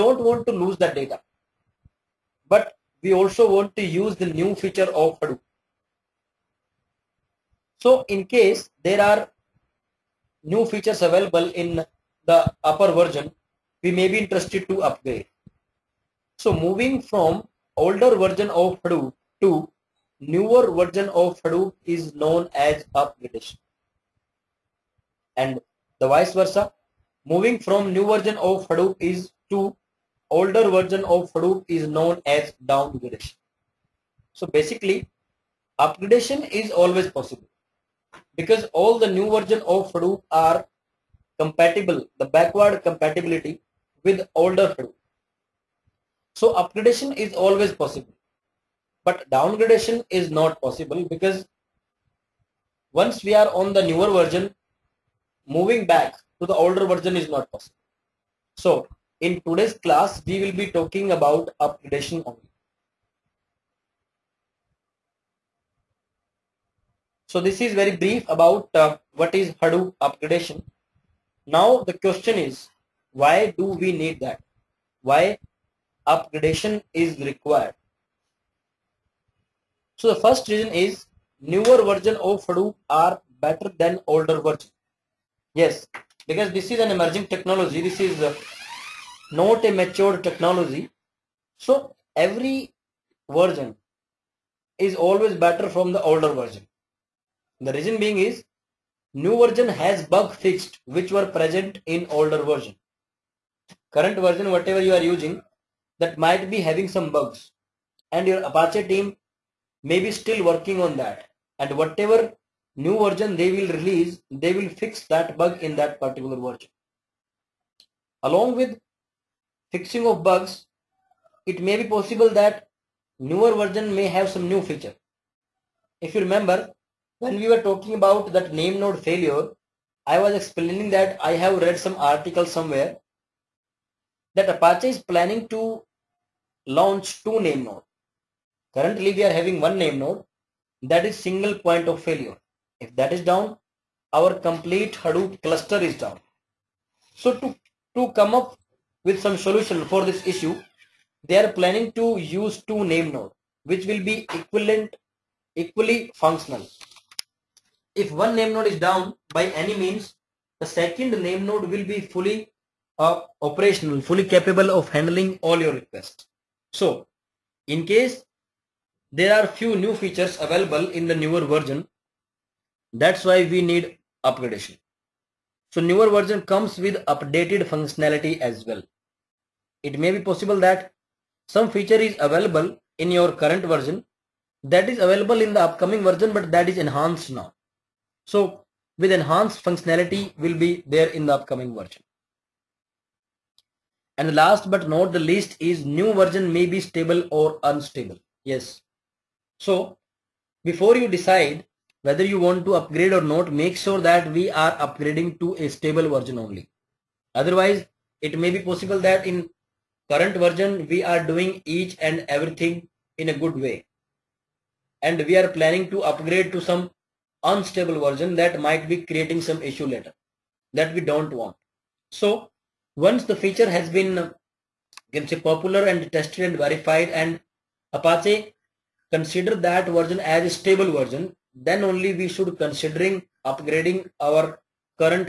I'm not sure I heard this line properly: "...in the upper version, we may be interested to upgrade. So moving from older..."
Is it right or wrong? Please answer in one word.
right.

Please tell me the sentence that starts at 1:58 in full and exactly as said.
Along with fixing of bugs it may be possible that newer version may have some new feature.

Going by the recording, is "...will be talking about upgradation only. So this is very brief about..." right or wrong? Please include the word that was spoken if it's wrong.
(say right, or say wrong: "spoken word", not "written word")
right.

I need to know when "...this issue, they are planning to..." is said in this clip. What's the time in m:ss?
2:30.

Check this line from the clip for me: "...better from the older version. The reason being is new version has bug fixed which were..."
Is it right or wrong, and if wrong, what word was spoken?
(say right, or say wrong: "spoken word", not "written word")
right.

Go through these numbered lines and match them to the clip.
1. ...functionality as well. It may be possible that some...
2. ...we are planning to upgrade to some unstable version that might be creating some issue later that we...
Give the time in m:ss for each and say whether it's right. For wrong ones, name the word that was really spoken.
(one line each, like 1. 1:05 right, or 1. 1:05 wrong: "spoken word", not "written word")
1. 2:57 right
2. 3:35 right.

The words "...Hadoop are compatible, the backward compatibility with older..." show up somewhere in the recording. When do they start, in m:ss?
0:39.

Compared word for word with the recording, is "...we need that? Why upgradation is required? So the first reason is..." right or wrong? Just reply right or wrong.
right.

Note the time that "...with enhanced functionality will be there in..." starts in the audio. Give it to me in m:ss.
3:08.